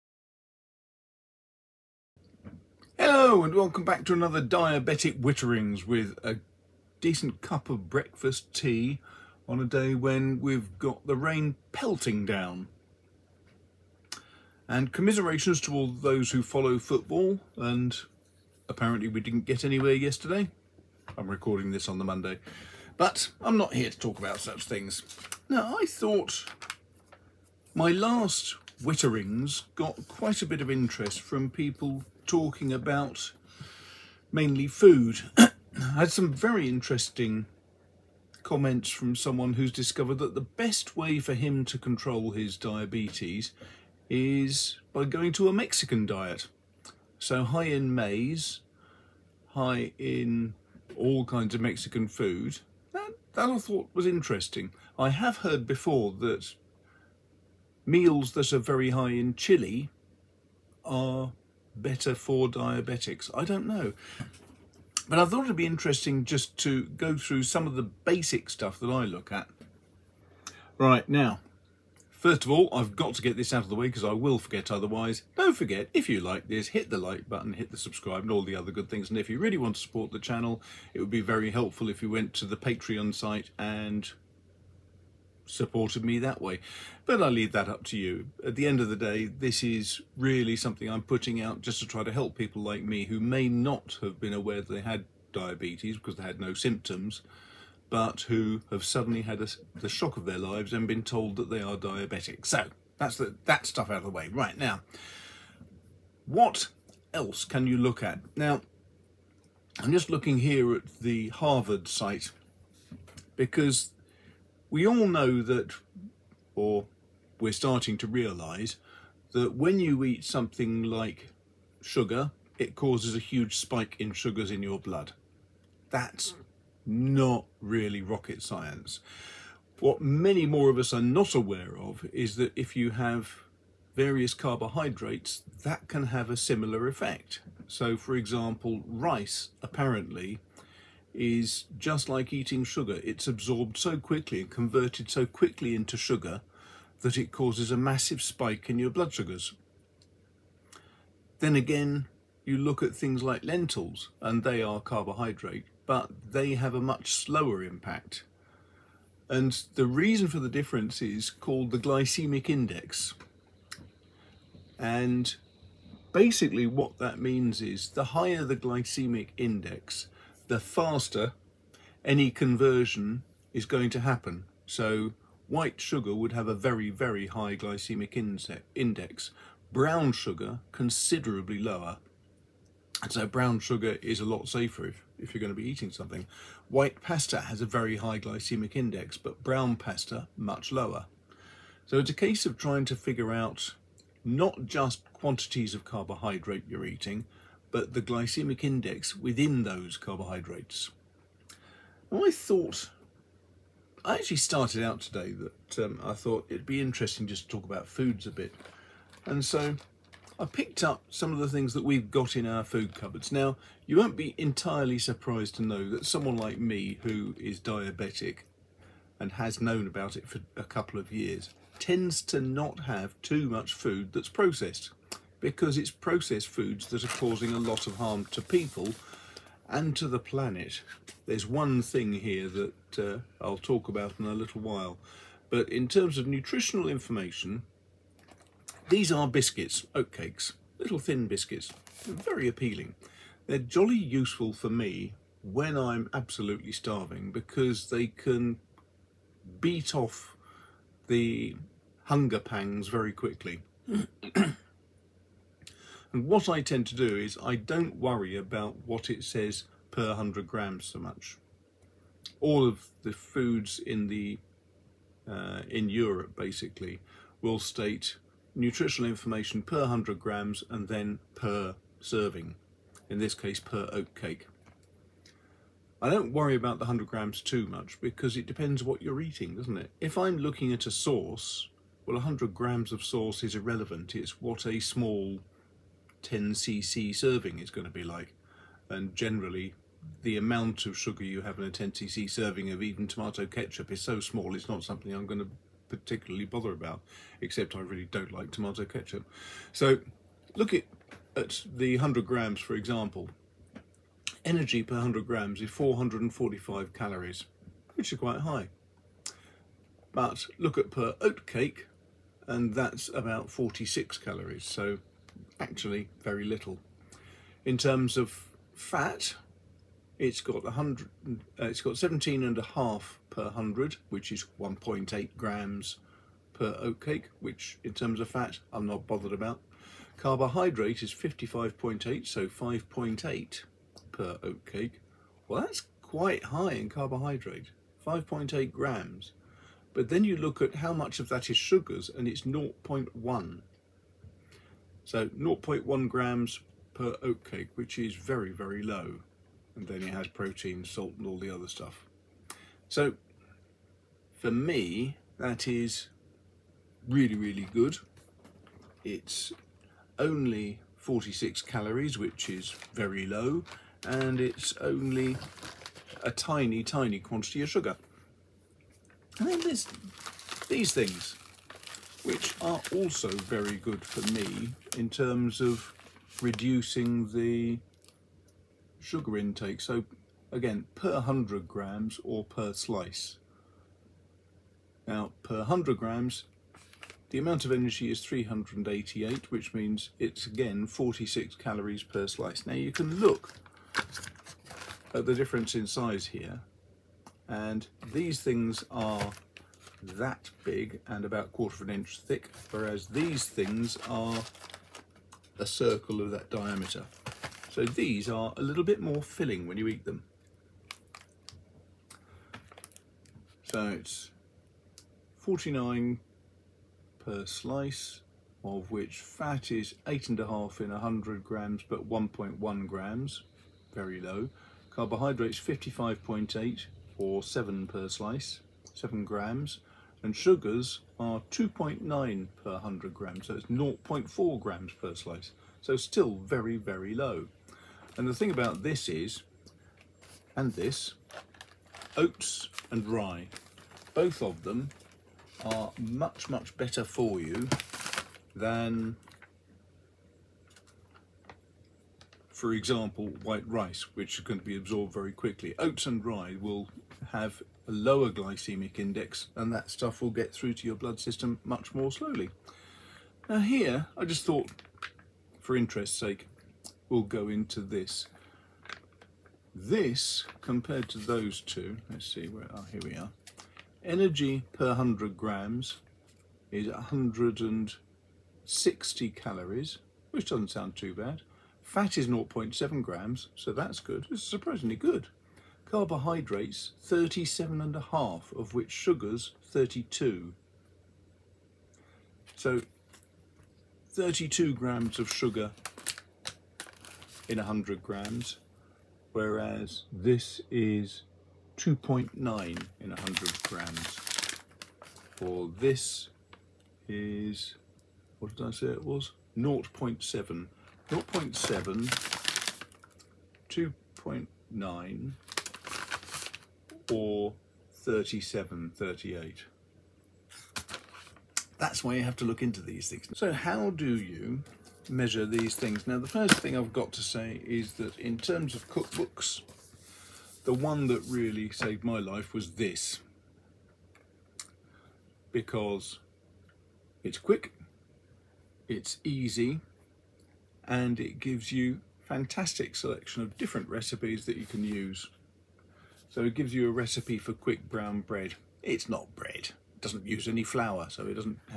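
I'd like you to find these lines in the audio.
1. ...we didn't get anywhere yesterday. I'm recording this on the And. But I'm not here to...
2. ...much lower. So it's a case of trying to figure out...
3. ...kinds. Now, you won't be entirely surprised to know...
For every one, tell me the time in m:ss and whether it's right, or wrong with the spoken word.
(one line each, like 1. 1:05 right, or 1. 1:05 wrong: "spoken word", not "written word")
1. 0:19 wrong: "Monday", not "And"
2. 3:10 right
3. 3:32 wrong: "cupboards", not "kinds".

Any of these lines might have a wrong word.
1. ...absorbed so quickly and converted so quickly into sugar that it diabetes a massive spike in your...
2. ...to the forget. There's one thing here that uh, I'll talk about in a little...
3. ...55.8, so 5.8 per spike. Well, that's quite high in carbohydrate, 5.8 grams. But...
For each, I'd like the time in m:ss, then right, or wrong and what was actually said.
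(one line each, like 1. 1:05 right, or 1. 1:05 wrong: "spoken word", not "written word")
1. 2:23 wrong: "causes", not "diabetes"
2. 3:49 wrong: "planet", not "forget"
3. 5:31 wrong: "oatcake", not "spike".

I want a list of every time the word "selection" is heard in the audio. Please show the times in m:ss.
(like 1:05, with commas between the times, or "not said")
9:02.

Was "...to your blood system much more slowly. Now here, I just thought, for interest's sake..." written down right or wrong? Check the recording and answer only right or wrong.
right.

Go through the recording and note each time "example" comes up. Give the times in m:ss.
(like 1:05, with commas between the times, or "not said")
2:18, 5:02, 7:32.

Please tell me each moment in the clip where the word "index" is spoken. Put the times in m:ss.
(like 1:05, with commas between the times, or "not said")
2:42, 2:49, 2:58, 3:08, 3:18, 7:38.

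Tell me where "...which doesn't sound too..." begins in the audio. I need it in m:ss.
8:00.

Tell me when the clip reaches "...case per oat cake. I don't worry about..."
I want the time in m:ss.
4:33.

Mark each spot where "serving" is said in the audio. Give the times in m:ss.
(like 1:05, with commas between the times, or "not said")
4:31, 4:47, 4:52.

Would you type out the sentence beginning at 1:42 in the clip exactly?
So that's the, that stuff out of the way.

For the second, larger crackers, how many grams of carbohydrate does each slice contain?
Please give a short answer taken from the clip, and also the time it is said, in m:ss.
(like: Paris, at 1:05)
7, at 7:08.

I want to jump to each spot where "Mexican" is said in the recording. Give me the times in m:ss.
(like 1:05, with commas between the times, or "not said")
0:45, 0:51.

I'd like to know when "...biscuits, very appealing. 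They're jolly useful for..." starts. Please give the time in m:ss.
4:01.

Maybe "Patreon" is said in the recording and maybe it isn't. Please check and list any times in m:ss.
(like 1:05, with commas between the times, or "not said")
1:22.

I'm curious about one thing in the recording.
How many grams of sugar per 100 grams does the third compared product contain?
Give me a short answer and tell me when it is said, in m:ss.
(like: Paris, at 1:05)
32, at 8:08.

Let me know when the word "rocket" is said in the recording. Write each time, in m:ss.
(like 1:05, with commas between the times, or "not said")
2:08.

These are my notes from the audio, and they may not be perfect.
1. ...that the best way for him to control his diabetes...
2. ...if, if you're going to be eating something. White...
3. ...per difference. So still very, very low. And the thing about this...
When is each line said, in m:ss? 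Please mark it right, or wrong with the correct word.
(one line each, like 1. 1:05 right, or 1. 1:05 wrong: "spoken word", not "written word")
1. 0:40 right
2. 3:04 right
3. 7:14 wrong: "slice", not "difference".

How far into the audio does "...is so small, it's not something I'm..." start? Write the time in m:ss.
4:53.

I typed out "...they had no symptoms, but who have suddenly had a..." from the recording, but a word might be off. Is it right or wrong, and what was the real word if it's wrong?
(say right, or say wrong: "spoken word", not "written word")
right.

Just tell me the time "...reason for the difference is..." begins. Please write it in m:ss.
2:39.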